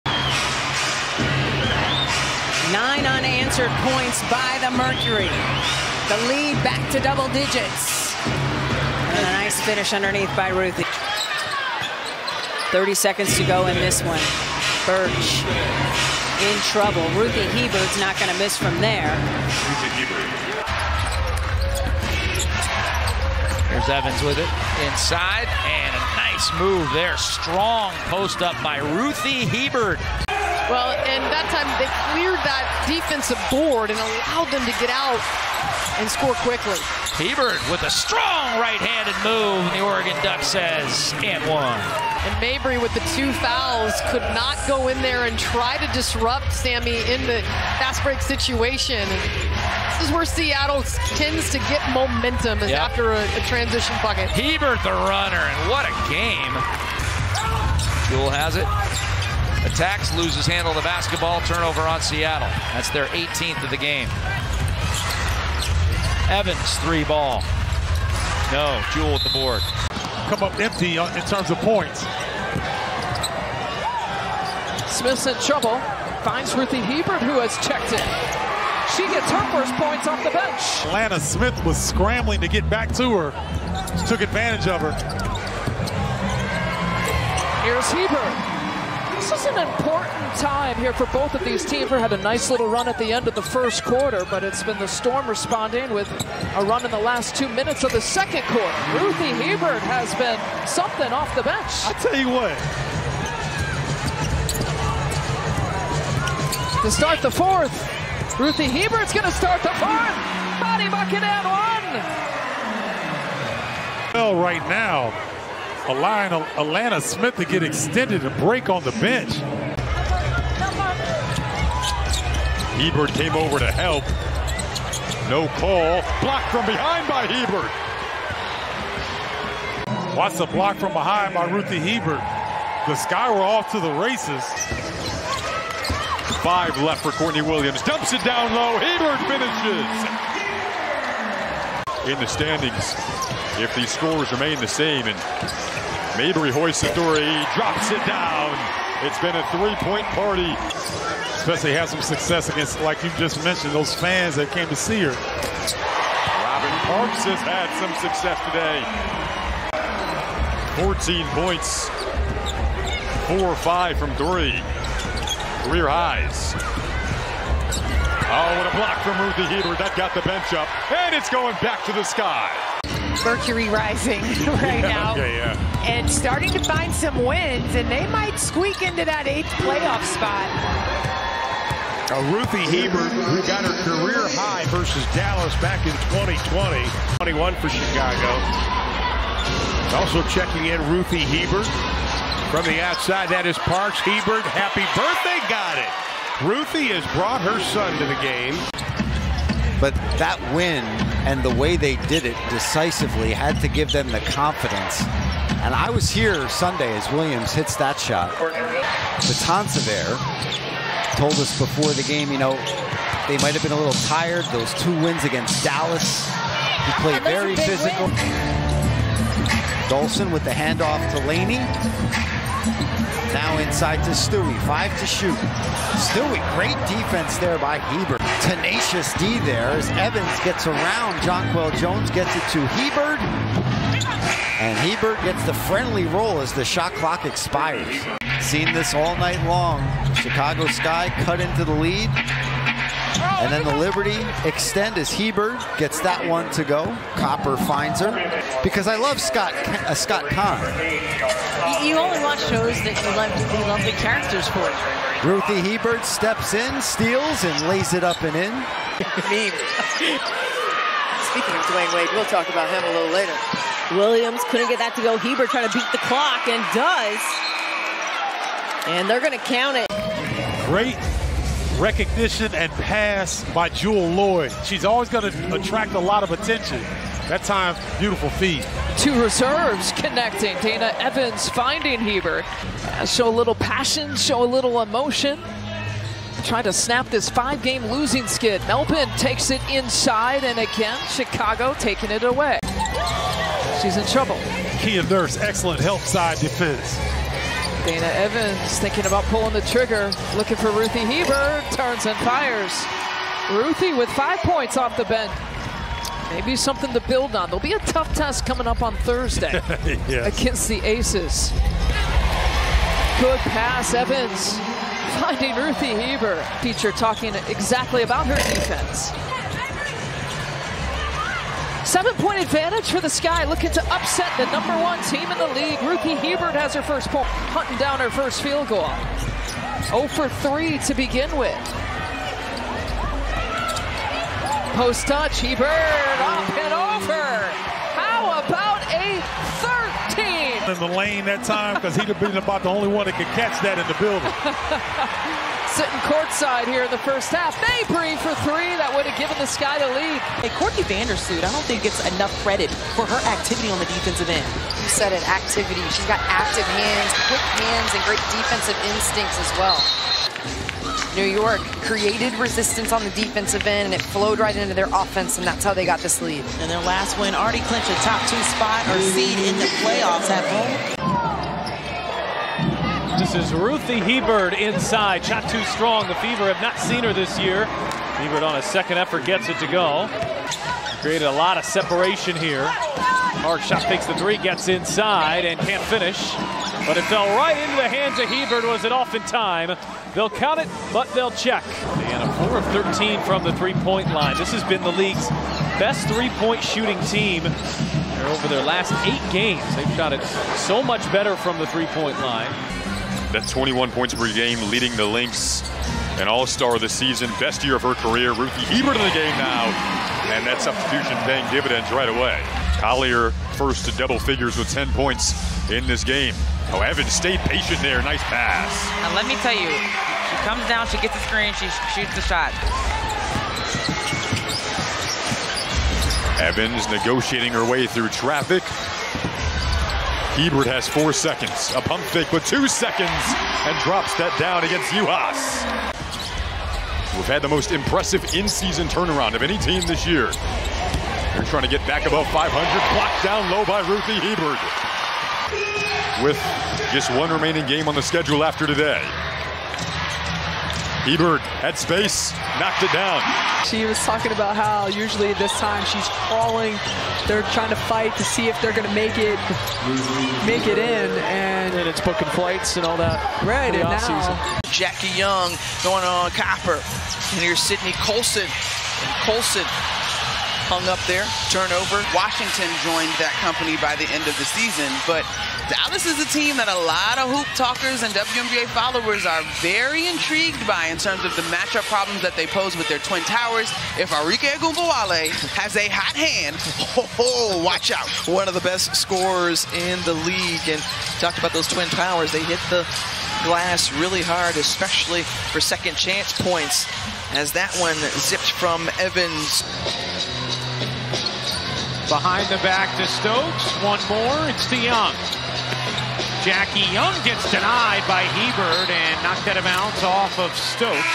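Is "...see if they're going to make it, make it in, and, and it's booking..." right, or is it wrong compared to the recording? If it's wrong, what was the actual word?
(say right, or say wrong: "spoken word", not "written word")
right.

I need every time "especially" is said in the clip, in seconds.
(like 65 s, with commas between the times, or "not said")
151 s, 494 s.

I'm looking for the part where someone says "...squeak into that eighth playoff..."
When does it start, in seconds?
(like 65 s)
178 s.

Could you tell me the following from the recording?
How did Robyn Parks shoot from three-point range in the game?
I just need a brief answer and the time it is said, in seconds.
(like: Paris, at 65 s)
4 of 5, at 163 s.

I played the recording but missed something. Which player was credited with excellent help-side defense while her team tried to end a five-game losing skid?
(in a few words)
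Kia Nurse.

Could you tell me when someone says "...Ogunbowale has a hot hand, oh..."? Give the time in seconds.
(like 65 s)
484 s.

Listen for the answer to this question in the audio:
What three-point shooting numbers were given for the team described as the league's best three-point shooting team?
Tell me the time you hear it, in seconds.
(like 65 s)
392 s.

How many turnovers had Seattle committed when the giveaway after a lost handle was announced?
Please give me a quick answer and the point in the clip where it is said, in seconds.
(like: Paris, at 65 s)
18, at 63 s.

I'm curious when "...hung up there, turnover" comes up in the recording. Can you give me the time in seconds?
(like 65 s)
470 s.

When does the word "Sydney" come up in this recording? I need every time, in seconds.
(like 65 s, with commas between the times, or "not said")
467 s.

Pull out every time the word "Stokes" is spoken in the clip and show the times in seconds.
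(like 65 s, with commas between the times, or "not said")
503 s, 510 s.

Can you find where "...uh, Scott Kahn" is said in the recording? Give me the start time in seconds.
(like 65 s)
249 s.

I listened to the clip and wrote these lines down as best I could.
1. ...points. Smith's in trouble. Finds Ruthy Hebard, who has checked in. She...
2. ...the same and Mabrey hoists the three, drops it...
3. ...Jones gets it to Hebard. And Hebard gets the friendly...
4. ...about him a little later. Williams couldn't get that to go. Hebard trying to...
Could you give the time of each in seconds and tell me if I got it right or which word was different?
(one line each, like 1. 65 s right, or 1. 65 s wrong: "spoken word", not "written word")
1. 71 s right
2. 144 s right
3. 231 s right
4. 262 s right.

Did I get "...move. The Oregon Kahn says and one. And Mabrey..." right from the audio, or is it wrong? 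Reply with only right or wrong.
wrong.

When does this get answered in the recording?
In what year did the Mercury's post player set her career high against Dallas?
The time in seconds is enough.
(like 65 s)
186 s.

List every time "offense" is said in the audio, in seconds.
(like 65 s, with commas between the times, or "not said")
364 s.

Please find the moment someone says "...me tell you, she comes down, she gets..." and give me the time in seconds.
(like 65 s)
419 s.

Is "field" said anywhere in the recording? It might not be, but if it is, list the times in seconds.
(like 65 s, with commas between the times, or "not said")
328 s.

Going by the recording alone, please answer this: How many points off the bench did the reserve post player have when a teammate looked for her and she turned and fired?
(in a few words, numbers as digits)
5.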